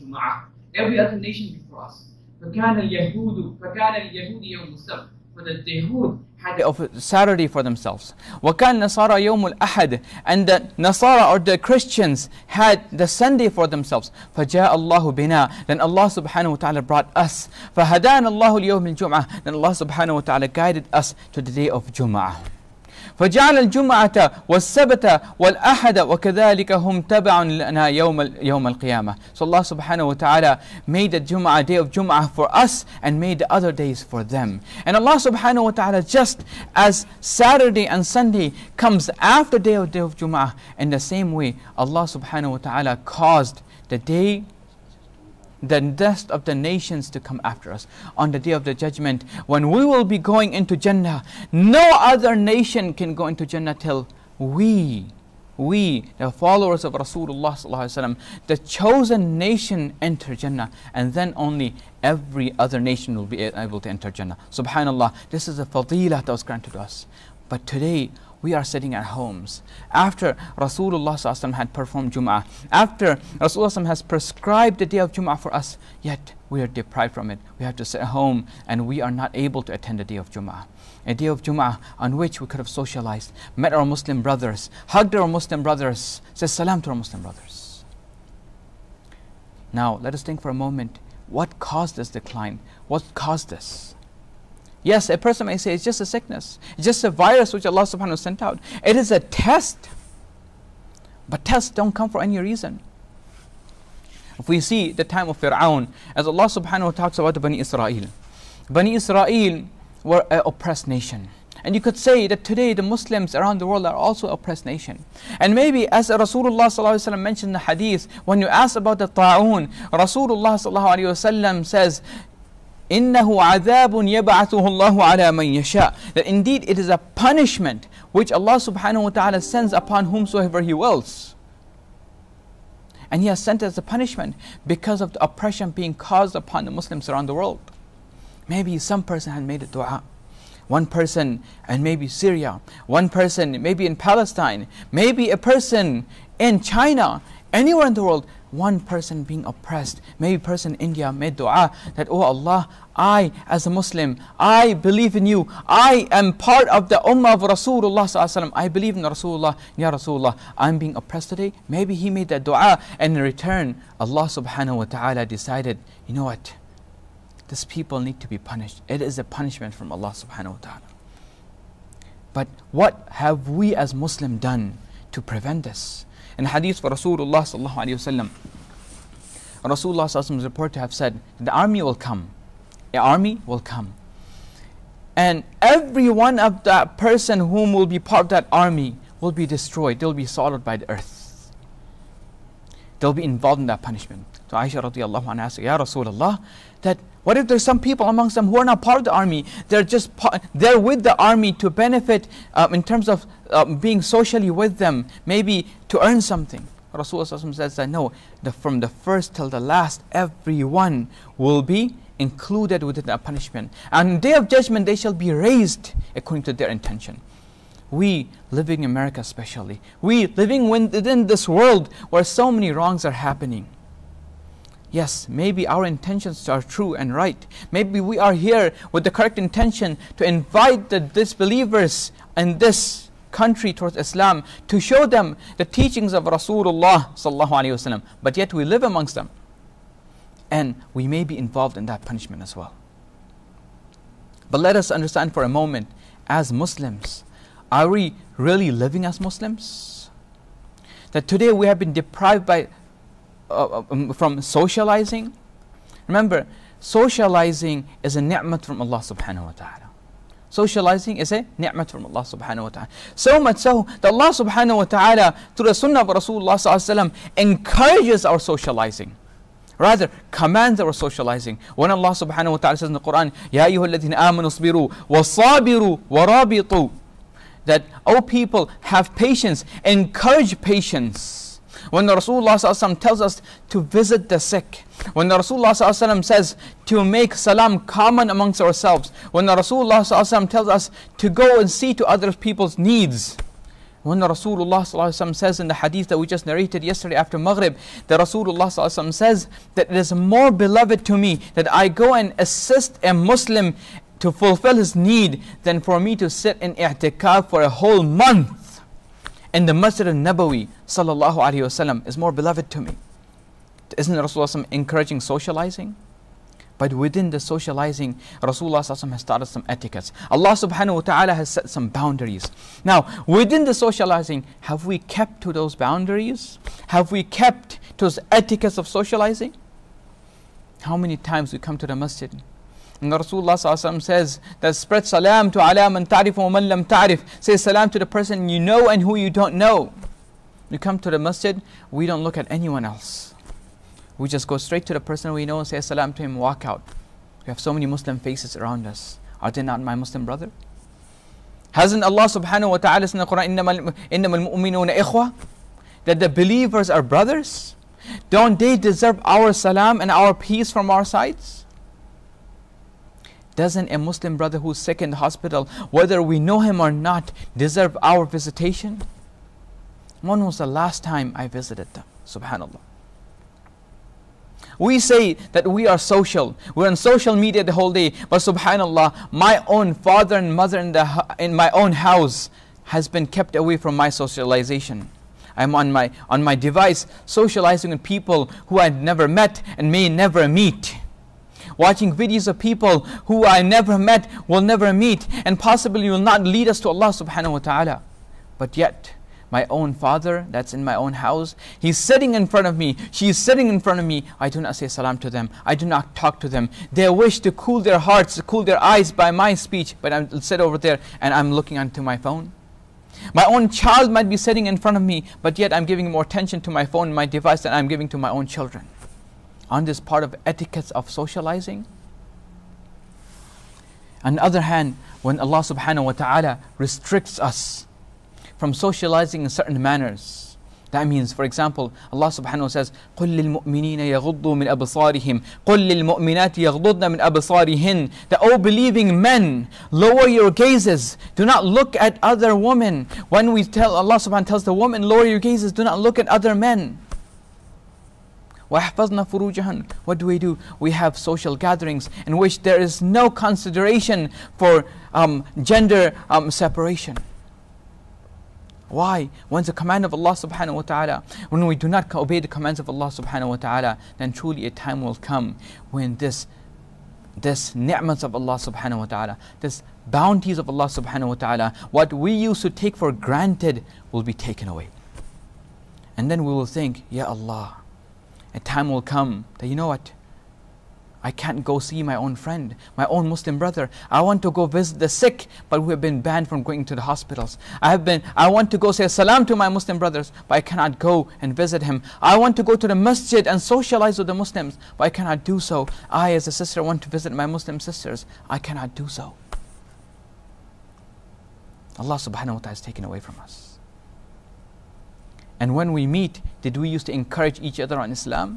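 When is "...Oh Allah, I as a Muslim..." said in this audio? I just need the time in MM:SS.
02:32.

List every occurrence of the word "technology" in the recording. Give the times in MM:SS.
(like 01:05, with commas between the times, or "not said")
not said.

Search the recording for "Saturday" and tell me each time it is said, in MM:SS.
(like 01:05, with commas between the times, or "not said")
00:07, 00:37.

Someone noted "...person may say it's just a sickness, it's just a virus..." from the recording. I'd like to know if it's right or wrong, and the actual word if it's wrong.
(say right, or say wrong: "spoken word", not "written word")
right.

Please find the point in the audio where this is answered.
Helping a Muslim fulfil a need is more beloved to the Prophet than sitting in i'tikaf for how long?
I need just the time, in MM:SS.
05:07.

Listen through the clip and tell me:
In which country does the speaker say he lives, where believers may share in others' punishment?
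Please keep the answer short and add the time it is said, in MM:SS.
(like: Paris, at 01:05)
America, at 03:38.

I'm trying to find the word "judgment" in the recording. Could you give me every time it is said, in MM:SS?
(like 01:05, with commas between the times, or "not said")
00:48, 03:34.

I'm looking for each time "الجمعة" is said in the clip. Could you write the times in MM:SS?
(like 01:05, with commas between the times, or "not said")
00:18, 00:23.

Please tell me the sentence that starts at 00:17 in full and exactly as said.
فَهَدَانَ اللَّهُ الْيَوْمِ الْجُمْعَةِ Then Allah subhanahu wa ta'ala guided us to the day of Jum'ah.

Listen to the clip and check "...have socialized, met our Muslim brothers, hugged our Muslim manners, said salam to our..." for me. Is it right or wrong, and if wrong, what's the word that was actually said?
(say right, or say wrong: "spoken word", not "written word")
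wrong: "brothers", not "manners".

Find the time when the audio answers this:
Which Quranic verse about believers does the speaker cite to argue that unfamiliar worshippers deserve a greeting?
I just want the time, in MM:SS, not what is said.
05:56.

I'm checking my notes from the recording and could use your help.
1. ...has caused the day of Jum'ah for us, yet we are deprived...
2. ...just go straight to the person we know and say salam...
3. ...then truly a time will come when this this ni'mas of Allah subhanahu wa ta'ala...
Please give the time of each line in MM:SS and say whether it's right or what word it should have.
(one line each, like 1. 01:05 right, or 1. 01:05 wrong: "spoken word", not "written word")
1. 01:13 wrong: "prescribed", not "caused"
2. 05:44 right
3. 07:44 right.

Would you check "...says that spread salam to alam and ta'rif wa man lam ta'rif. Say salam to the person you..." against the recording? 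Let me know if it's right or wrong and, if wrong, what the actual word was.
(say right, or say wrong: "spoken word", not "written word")
right.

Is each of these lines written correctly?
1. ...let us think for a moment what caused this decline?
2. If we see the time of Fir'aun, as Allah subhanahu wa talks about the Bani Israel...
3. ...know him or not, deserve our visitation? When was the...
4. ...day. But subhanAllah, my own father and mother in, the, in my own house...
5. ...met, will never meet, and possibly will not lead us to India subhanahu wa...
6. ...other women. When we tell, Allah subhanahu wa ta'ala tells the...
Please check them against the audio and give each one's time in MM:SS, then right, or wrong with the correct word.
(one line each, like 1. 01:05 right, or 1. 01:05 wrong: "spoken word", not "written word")
1. 01:30 right
2. 01:44 right
3. 06:06 right
4. 06:17 right
5. 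06:33 wrong: "Allah", not "India"
6. 07:22 right.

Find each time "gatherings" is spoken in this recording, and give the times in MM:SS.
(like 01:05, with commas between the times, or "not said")
07:31.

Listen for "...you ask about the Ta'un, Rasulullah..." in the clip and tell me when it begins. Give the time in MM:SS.
01:58.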